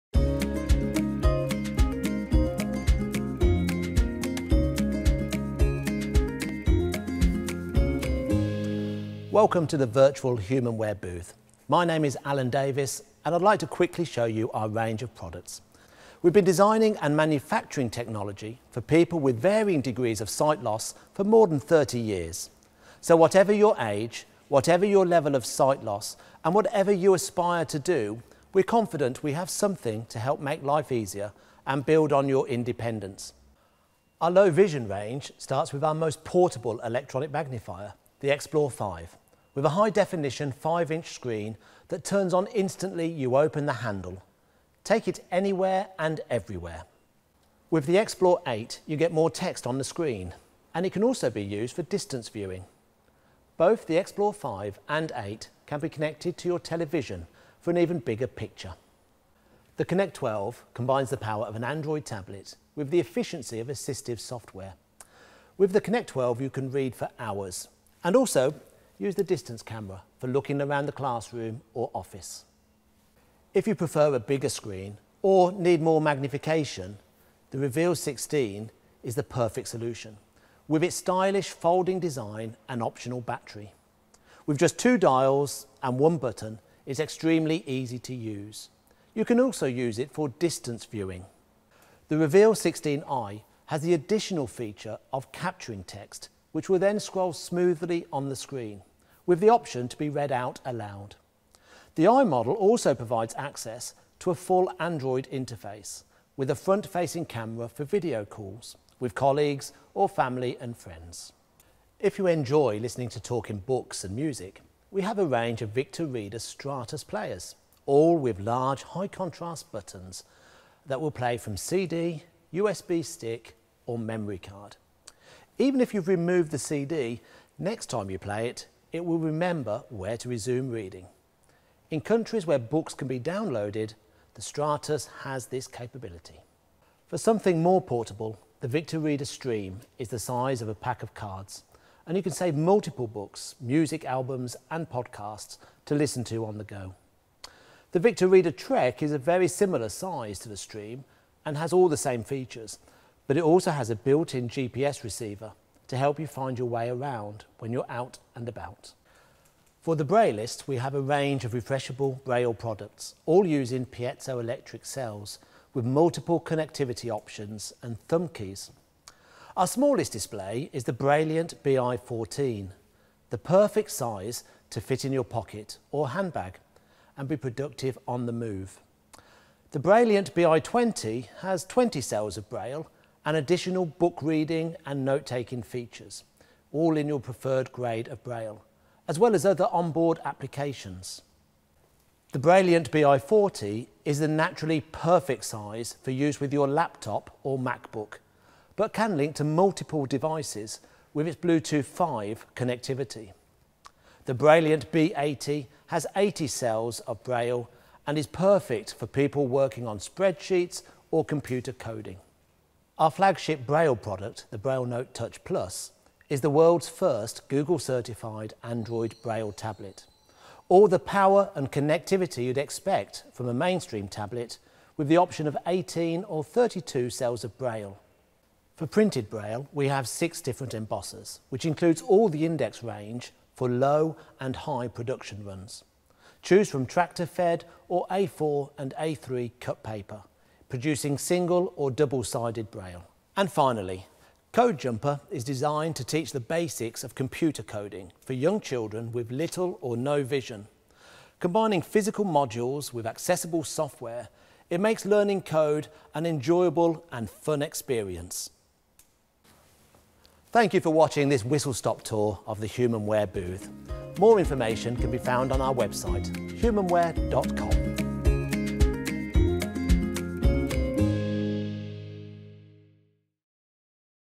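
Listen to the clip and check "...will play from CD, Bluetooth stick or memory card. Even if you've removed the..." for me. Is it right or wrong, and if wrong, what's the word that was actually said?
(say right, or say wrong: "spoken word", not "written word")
wrong: "USB", not "Bluetooth".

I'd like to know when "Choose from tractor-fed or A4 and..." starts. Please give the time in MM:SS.
03:56.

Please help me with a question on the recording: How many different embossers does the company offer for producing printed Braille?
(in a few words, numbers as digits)
6.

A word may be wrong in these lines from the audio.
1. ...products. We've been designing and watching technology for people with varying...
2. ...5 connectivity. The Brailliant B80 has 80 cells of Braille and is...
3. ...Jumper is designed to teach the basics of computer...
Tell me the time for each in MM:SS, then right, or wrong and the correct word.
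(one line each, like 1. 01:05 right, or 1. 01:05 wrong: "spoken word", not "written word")
1. 00:15 wrong: "manufacturing", not "watching"
2. 03:21 right
3. 04:04 right.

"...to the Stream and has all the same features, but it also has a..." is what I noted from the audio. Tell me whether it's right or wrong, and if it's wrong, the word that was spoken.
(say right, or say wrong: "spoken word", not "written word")
right.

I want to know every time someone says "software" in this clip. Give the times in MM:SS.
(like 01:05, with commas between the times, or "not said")
01:04, 04:13.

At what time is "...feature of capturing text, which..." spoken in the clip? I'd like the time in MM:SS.
01:34.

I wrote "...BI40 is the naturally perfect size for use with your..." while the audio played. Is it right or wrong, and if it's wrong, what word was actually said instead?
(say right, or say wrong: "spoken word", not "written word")
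right.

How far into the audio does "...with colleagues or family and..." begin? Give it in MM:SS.
01:48.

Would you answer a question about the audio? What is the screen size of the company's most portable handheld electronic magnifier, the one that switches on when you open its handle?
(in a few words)
5-inch.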